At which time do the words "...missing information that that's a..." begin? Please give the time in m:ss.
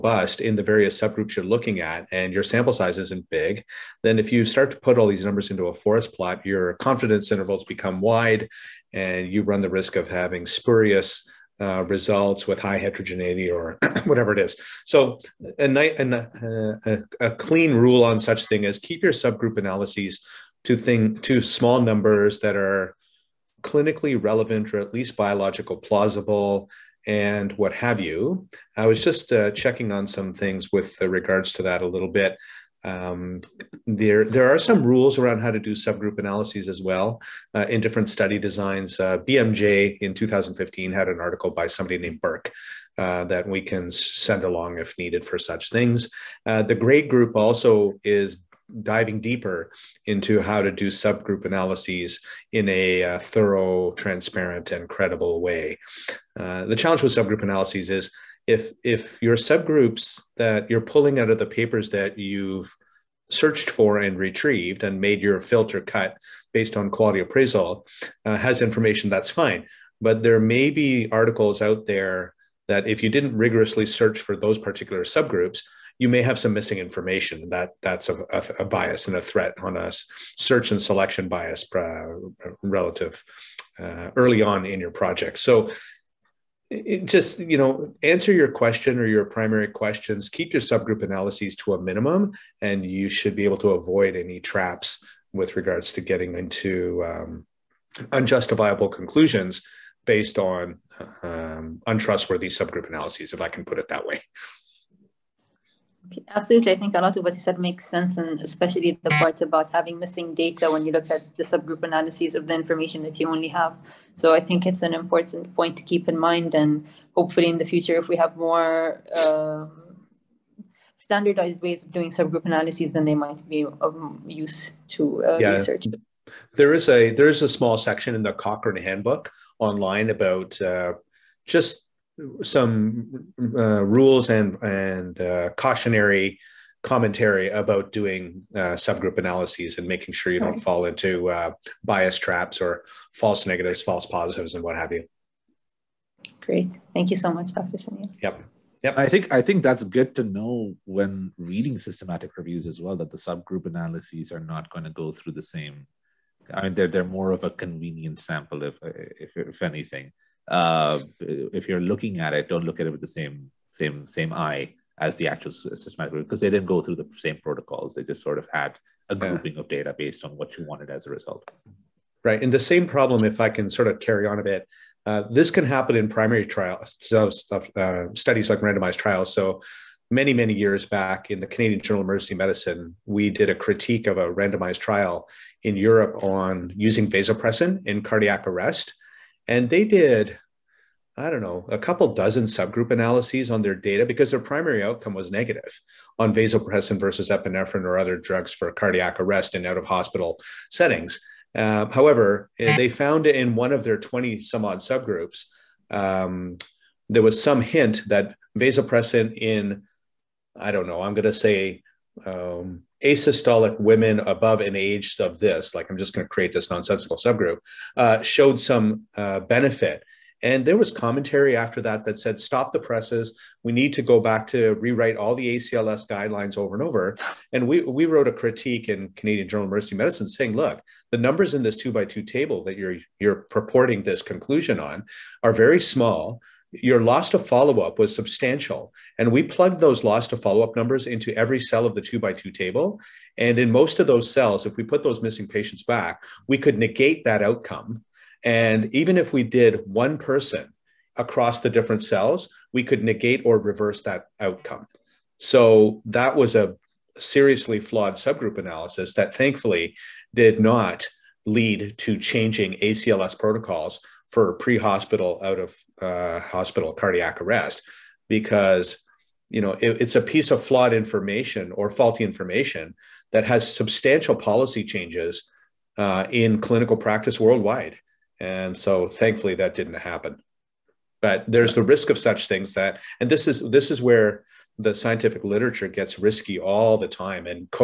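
1:16.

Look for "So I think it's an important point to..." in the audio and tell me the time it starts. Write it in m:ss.
1:54.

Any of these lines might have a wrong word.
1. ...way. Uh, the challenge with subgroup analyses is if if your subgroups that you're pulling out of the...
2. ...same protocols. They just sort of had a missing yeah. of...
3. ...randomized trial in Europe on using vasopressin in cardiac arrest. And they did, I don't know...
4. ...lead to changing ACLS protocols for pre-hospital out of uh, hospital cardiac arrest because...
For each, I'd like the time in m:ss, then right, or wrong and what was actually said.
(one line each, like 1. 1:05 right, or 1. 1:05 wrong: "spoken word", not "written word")
1. 0:55 right
2. 2:47 wrong: "grouping", not "missing"
3. 3:04 right
4. 4:21 right.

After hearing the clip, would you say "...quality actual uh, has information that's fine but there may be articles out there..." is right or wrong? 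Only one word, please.
wrong.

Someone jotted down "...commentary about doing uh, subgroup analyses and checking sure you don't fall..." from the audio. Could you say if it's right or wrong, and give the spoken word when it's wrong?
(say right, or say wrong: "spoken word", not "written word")
wrong: "making", not "checking".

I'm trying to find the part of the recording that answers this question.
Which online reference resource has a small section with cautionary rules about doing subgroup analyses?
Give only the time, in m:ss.
2:08.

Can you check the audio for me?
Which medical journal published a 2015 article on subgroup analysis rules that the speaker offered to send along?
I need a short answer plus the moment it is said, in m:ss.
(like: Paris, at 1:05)
BMJ, at 0:39.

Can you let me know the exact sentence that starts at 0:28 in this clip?
I was just uh, checking on some things with uh, regards to that a little bit.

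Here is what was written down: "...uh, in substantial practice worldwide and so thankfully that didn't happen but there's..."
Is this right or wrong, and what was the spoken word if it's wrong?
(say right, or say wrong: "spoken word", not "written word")
wrong: "clinical", not "substantial".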